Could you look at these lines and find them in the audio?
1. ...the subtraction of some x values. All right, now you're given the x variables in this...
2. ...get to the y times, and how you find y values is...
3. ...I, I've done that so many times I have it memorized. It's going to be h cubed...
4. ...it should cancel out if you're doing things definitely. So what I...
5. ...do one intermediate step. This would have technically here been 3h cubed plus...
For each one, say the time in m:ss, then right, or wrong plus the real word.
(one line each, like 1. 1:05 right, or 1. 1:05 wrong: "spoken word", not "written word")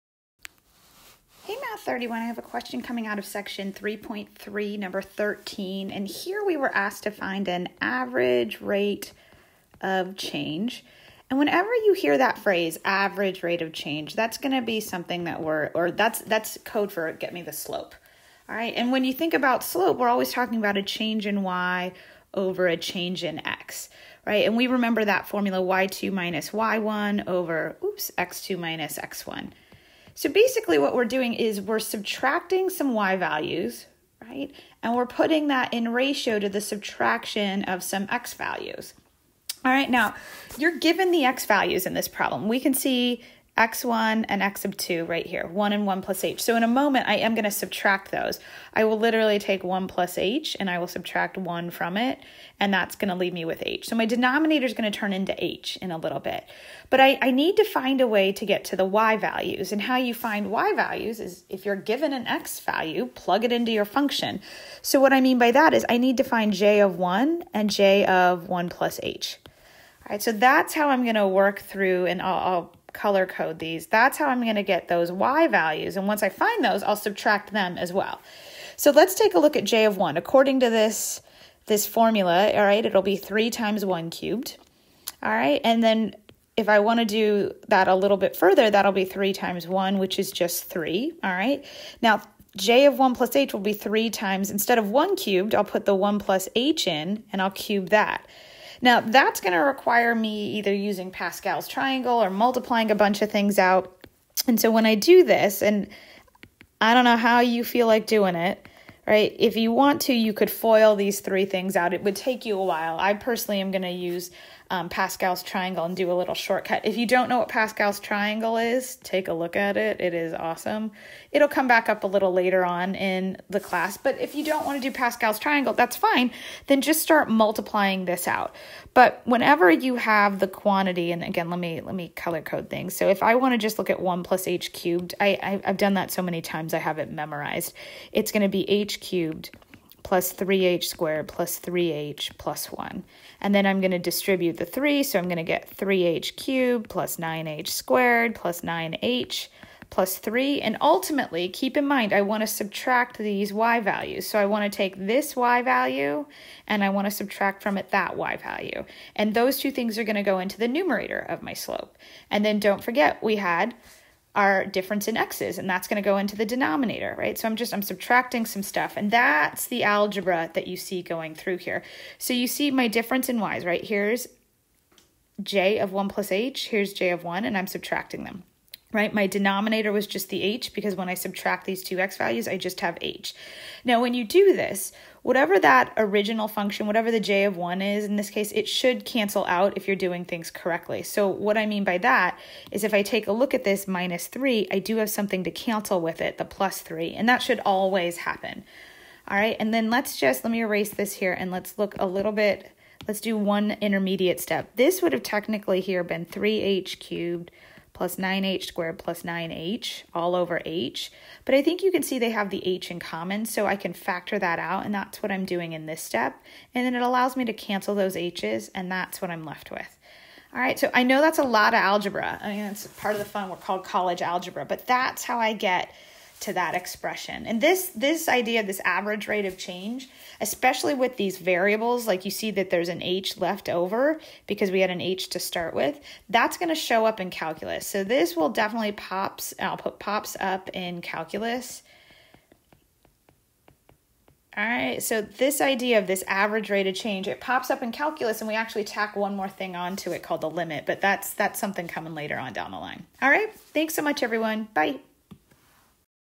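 1. 0:36 wrong: "values", not "variables"
2. 0:58 wrong: "values", not "times"
3. 2:15 right
4. 3:08 wrong: "correctly", not "definitely"
5. 3:23 right.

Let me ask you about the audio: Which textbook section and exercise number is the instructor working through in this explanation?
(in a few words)
Section 3.3, number 13.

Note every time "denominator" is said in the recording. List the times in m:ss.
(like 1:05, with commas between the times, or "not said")
0:54, 2:46, 2:59.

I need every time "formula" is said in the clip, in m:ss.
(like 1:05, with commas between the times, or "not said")
0:25, 1:21.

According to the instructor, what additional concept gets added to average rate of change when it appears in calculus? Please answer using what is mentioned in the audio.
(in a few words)
The limit.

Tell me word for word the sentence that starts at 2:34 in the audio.
So I want to take this y value and I want to subtract from it that y value.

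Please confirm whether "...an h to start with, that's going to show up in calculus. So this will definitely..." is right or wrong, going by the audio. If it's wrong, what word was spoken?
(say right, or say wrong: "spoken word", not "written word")
right.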